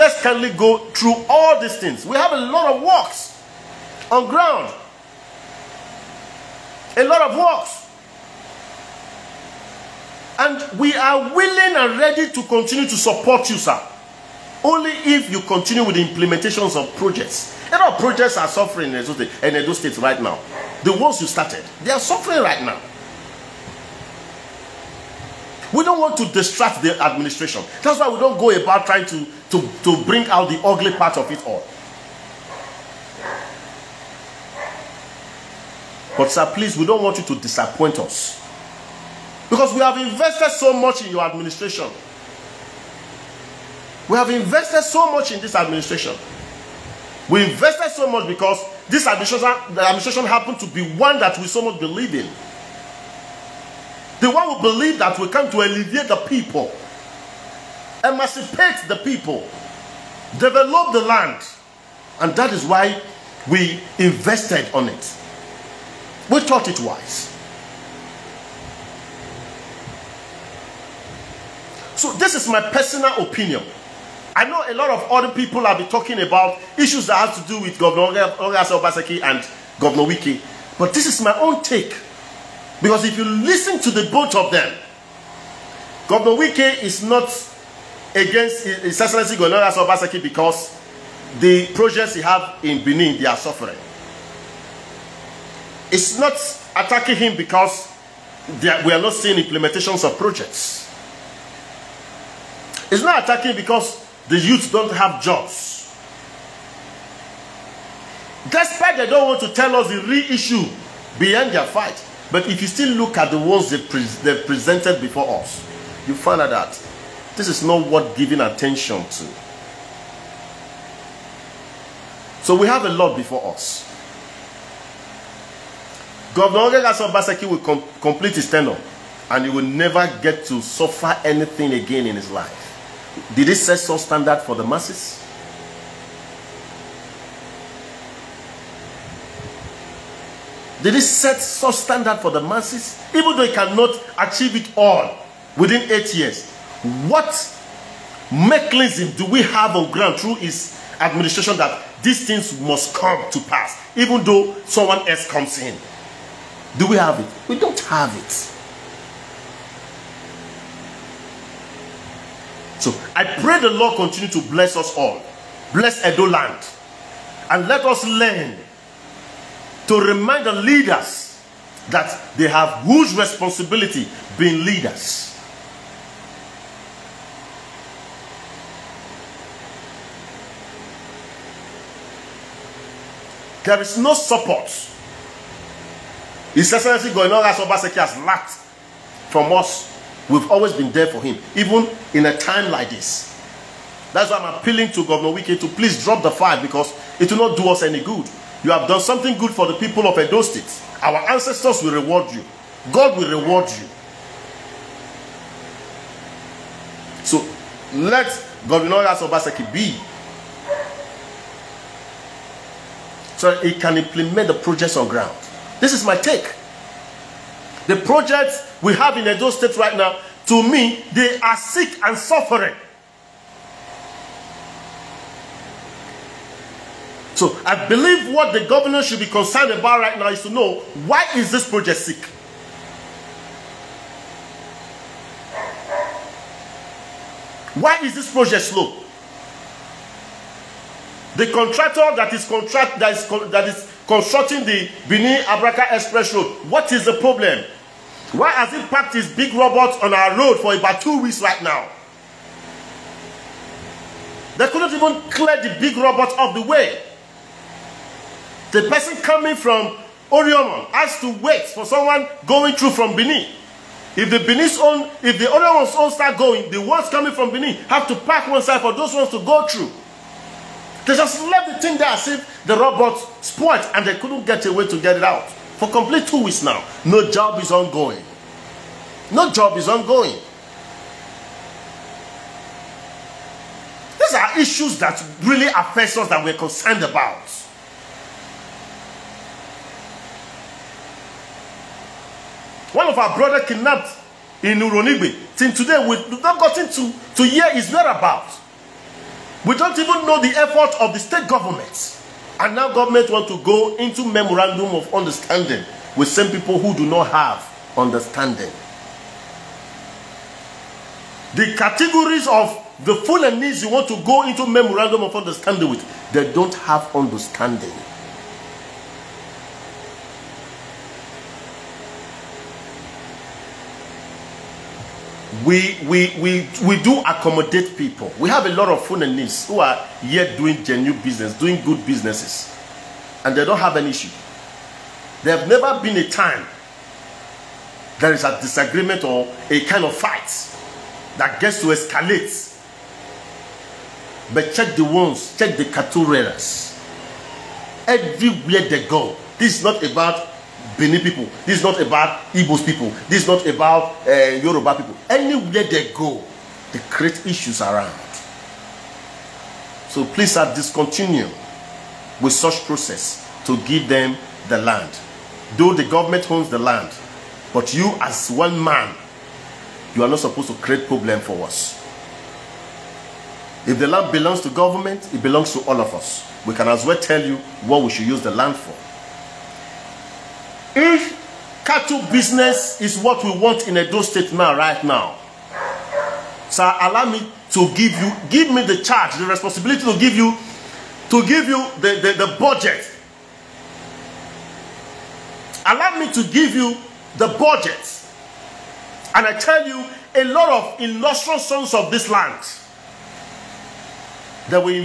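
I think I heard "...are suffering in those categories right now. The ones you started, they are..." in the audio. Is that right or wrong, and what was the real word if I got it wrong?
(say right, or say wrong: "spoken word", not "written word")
wrong: "states", not "categories".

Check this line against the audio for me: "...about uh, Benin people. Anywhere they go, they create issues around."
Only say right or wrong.
wrong.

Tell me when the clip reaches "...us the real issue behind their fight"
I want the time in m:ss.
1:49.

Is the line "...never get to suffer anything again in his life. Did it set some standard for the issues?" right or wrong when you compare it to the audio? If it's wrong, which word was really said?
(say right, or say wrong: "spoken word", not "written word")
wrong: "masses", not "issues".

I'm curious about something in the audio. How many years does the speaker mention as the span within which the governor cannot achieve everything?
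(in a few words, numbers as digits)
8 years.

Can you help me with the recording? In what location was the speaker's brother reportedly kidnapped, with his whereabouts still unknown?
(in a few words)
Uronigbe.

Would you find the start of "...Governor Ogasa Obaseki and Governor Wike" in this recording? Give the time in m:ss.
1:17.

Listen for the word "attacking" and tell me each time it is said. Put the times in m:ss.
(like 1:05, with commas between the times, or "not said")
1:36, 1:43.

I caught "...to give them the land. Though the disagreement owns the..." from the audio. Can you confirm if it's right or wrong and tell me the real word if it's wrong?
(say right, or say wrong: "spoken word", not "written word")
wrong: "government", not "disagreement".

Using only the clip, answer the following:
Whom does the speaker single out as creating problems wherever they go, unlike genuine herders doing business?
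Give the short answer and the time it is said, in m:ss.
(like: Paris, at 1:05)
cattle raiders, at 5:45.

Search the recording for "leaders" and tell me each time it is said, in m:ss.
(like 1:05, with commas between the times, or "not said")
2:50, 2:54.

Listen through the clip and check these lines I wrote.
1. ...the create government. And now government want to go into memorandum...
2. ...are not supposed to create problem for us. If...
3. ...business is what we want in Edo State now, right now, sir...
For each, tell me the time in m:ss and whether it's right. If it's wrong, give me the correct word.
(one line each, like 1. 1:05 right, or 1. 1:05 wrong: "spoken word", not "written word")
1. 5:01 wrong: "state", not "create"
2. 6:10 right
3. 6:22 right.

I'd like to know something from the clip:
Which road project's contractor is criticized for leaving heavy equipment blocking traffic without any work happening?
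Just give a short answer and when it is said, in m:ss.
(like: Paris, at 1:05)
Benin Abraka Express Road, at 4:05.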